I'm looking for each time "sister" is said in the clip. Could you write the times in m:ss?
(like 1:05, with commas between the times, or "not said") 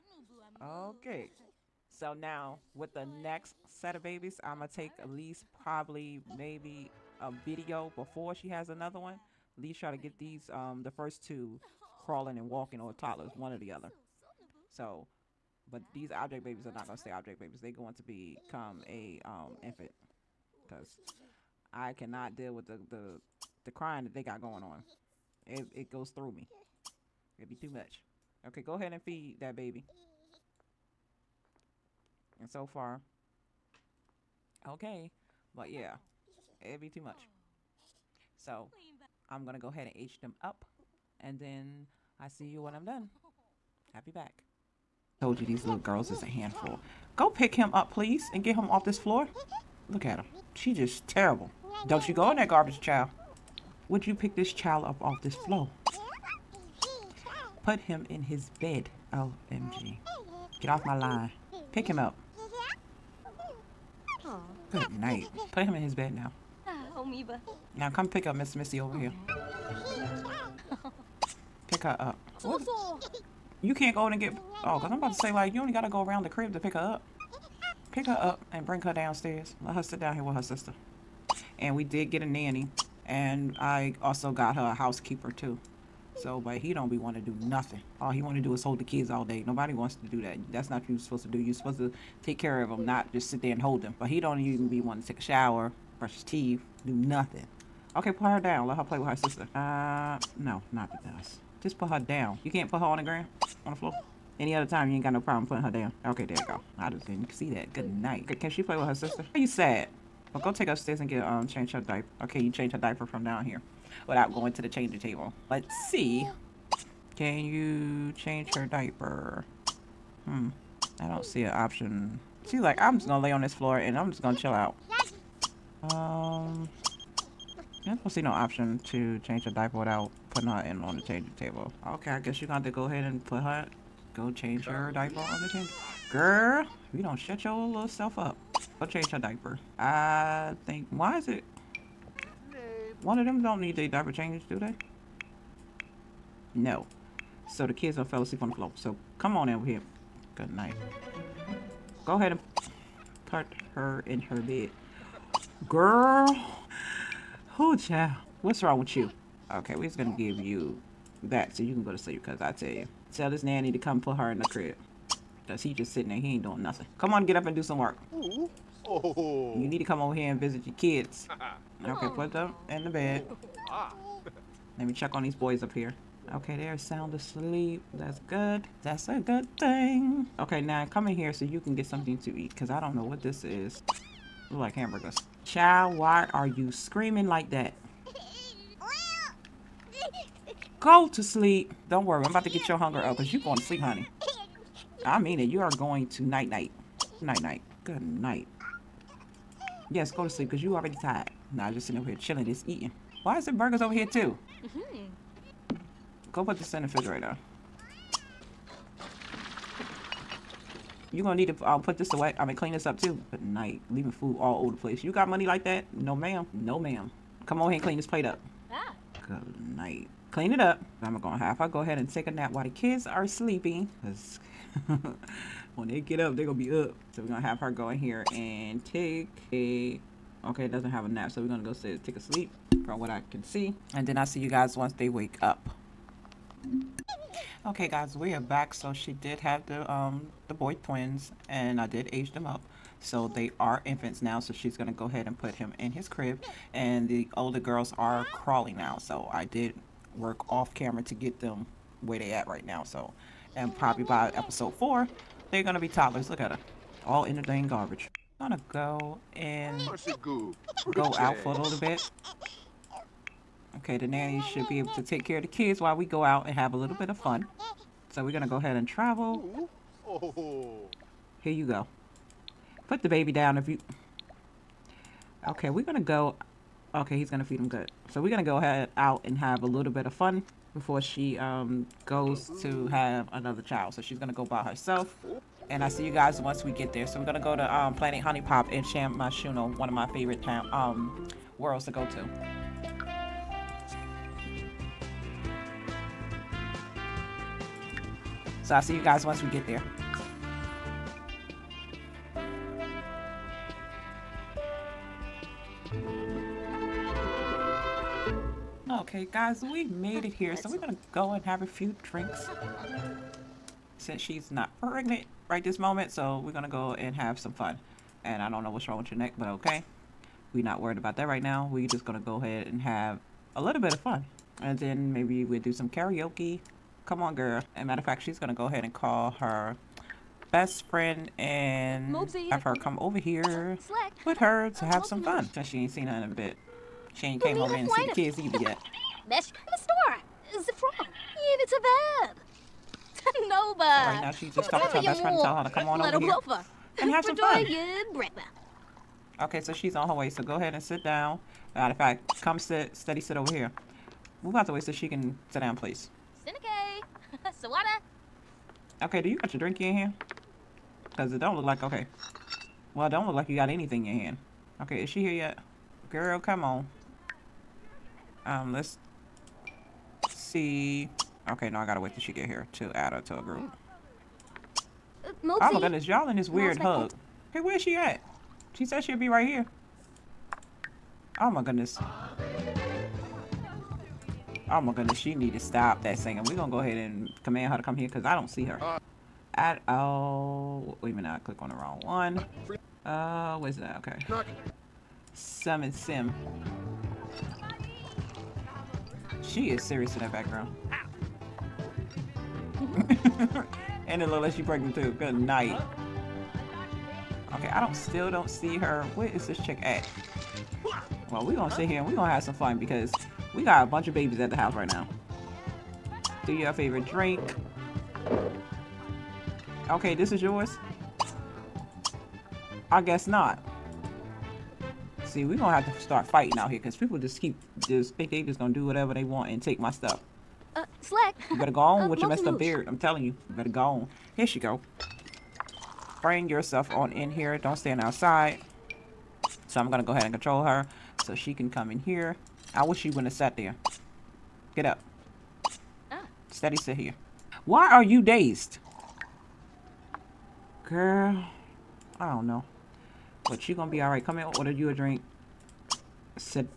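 1:20, 1:39, 1:48.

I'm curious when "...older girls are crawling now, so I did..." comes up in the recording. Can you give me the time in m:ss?
4:07.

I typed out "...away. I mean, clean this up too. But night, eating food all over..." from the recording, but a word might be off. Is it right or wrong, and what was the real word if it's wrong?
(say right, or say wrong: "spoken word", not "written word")
wrong: "leaving", not "eating".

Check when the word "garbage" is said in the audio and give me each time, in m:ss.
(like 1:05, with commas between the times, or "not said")
0:52, 4:17.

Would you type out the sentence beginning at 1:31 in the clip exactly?
you are supposed to take care of them, not just sit there and hold them.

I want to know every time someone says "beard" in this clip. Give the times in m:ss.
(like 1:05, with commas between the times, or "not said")
7:12.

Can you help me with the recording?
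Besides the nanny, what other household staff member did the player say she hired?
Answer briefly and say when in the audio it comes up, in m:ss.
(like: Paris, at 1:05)
housekeeper, at 1:24.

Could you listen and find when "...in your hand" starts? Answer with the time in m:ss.
6:04.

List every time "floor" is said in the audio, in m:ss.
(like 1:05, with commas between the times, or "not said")
0:48, 0:55, 1:43, 2:03, 2:28.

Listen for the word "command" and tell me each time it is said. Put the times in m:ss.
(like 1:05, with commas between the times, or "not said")
6:27.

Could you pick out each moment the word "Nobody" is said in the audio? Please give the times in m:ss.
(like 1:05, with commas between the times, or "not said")
1:29, 5:43.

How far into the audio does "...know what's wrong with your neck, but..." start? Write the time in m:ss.
5:18.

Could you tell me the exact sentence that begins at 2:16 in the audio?
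Girl, you don't shut your little self up.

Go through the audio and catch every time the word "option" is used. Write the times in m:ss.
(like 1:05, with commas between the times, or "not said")
2:01, 2:08.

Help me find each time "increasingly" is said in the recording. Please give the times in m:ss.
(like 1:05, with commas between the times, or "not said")
not said.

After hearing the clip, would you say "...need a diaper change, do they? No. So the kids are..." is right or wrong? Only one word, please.
right.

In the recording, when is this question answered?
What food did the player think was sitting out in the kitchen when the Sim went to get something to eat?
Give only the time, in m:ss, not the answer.
3:04.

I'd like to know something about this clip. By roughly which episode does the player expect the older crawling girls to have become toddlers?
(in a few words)
4.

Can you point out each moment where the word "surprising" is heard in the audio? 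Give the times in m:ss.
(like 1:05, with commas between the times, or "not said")
not said.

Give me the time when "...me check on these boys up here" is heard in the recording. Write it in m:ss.
2:54.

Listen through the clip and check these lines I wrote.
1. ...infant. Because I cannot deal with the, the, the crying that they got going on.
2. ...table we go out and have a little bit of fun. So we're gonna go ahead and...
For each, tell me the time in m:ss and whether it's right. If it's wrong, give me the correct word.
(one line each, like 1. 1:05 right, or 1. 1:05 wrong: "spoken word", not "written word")
1. 0:19 right
2. 4:25 wrong: "while", not "table".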